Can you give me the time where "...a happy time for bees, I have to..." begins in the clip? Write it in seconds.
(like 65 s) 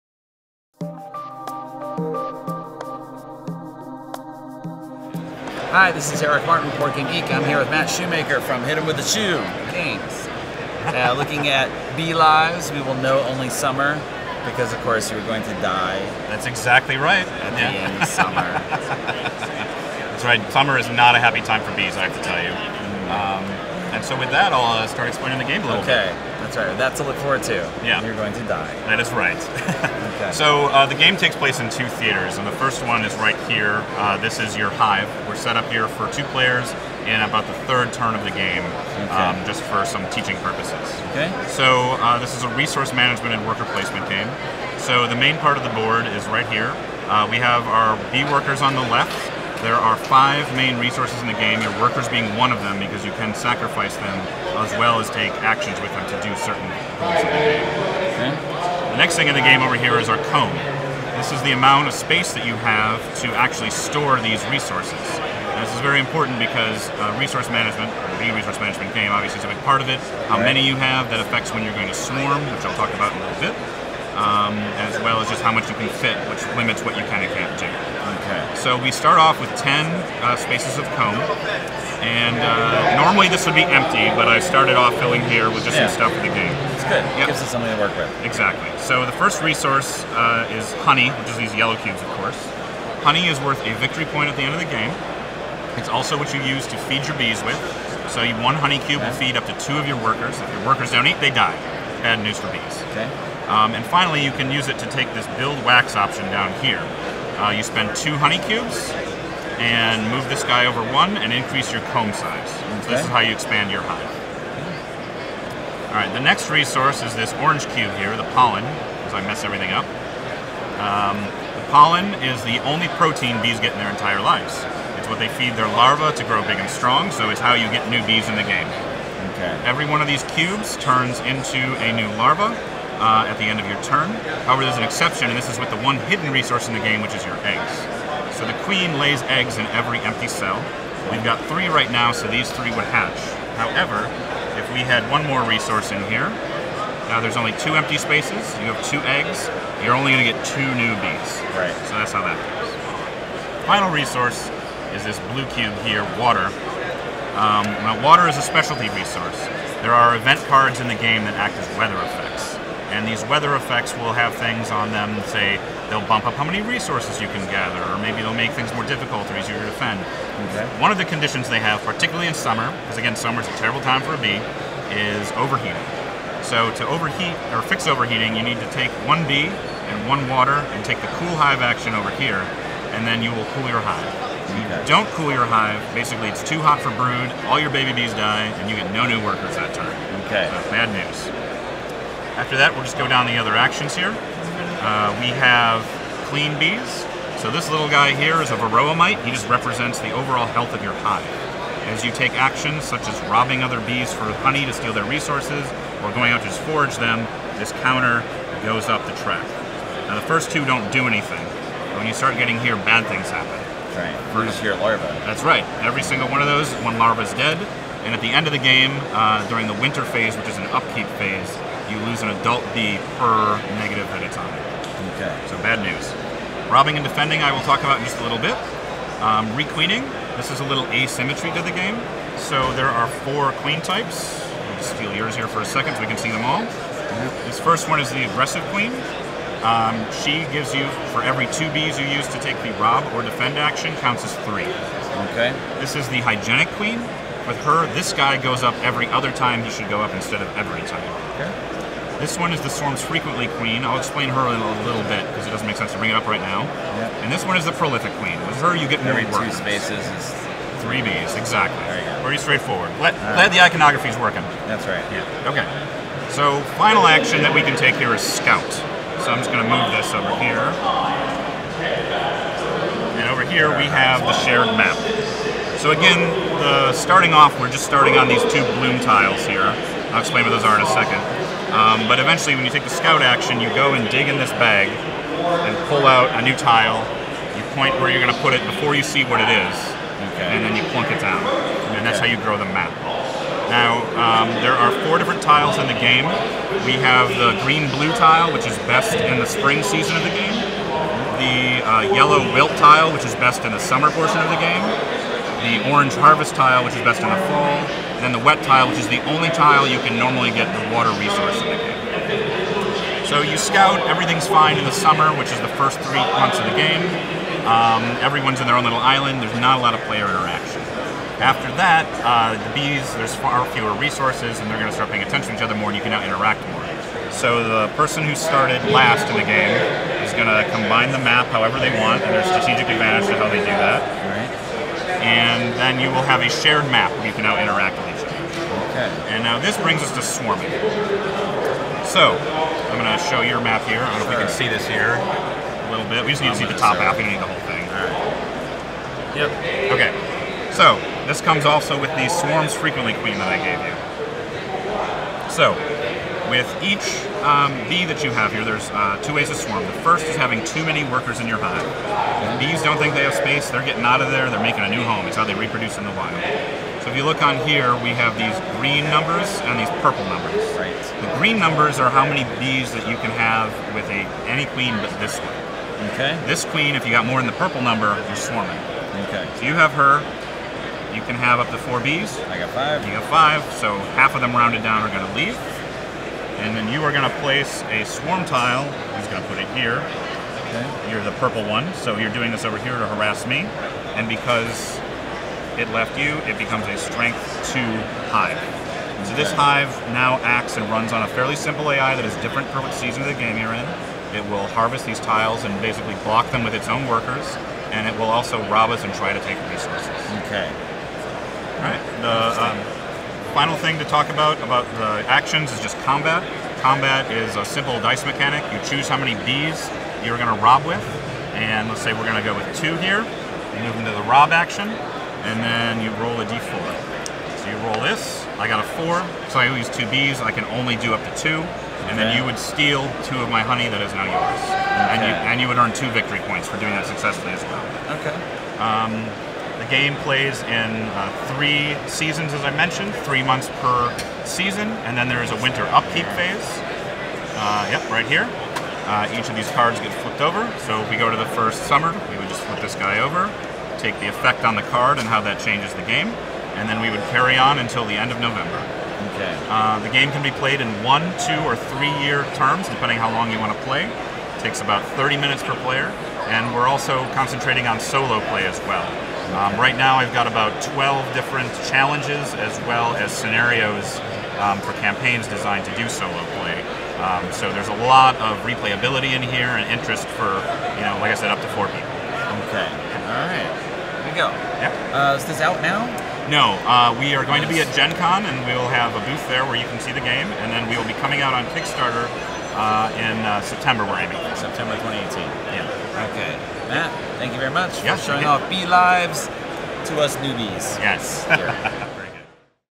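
21 s.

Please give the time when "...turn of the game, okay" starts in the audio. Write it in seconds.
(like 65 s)
37 s.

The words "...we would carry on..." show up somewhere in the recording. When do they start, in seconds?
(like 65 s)
457 s.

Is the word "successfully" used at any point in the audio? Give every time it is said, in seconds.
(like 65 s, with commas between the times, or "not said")
437 s.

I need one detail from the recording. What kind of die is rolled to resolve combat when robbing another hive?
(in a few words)
D4.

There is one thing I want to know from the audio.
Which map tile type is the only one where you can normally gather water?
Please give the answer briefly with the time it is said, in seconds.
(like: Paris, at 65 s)
Wet tile, at 308 s.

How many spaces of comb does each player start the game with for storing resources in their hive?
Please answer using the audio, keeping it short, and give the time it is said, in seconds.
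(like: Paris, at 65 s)
10, at 79 s.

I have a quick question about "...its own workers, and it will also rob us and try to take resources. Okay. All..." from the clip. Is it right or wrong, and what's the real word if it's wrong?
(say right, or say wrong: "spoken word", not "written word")
right.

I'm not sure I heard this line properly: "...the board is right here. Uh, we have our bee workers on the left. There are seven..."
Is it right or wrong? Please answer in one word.
wrong.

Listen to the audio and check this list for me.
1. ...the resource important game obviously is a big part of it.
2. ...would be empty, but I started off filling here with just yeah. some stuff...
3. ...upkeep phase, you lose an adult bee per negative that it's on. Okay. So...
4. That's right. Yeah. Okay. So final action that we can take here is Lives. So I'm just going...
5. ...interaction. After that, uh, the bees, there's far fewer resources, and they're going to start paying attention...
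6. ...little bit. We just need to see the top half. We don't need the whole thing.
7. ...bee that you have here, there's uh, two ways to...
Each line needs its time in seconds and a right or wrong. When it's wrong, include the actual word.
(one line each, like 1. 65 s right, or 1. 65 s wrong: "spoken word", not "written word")
1. 68 s wrong: "management", not "important"
2. 83 s right
3. 220 s right
4. 264 s wrong: "Scout", not "Lives"
5. 320 s right
6. 345 s right
7. 357 s right.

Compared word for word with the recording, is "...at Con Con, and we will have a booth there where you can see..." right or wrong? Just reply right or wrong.
wrong.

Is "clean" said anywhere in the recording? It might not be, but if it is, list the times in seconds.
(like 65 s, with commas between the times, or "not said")
196 s.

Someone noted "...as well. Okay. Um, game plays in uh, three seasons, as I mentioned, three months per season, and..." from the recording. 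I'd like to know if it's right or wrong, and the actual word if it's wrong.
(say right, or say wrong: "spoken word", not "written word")
right.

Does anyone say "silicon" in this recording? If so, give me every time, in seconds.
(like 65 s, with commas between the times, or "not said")
not said.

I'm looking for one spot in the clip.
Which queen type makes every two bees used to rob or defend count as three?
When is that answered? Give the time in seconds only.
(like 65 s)
238 s.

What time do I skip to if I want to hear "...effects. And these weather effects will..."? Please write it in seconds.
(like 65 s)
162 s.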